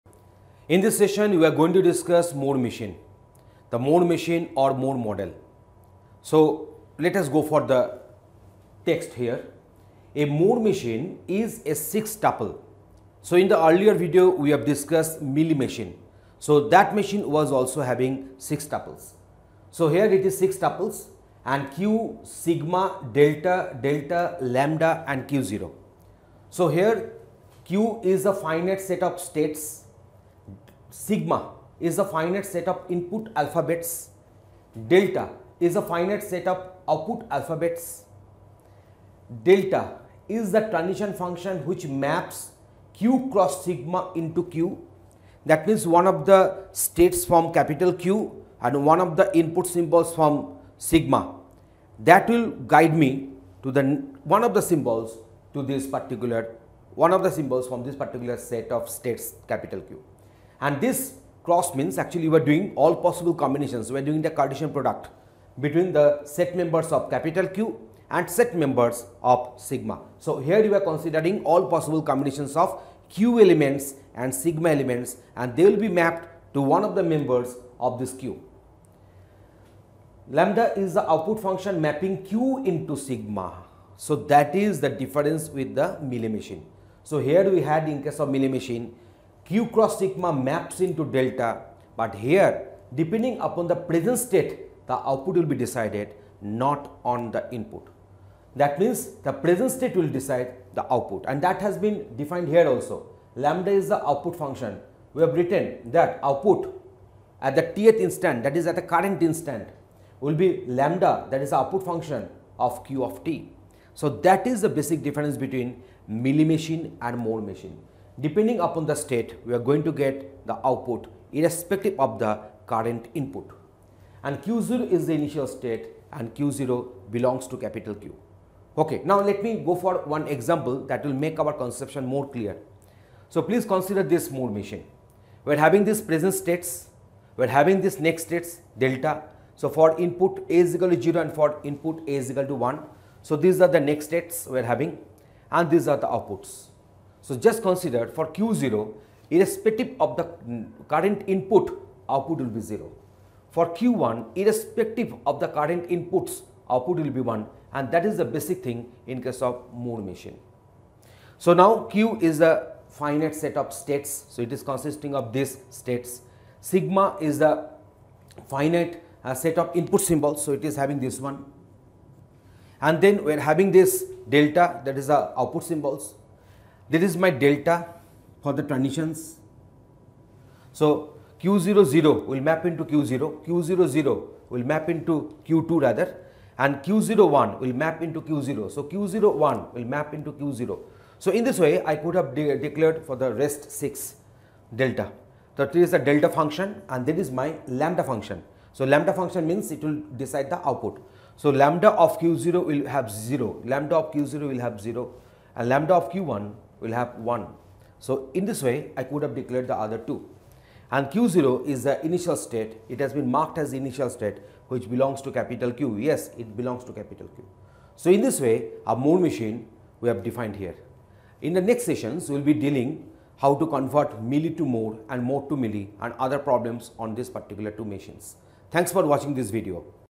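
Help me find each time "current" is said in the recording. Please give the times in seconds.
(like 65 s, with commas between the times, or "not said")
108 s, 122 s, 150 s, 155 s.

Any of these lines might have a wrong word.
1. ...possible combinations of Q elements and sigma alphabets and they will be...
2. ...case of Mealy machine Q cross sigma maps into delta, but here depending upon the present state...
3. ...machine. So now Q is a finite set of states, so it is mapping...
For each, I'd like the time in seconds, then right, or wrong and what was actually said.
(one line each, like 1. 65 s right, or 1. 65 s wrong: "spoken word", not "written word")
1. 71 s wrong: "elements", not "alphabets"
2. 88 s right
3. 160 s wrong: "consisting", not "mapping".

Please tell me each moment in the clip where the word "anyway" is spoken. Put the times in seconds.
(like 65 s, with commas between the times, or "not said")
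not said.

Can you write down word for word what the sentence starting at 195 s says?
So, this is the delta function and that is my lambda function.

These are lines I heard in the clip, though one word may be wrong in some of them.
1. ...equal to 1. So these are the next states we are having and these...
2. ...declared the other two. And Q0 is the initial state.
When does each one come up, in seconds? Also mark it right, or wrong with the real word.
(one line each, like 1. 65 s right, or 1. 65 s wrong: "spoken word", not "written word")
1. 142 s right
2. 209 s right.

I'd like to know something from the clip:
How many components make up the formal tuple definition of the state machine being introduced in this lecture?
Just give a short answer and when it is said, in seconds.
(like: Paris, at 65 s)
6, at 11 s.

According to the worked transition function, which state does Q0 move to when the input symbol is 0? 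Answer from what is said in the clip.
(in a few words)
Q2.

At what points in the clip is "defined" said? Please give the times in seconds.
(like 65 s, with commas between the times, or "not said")
102 s, 220 s.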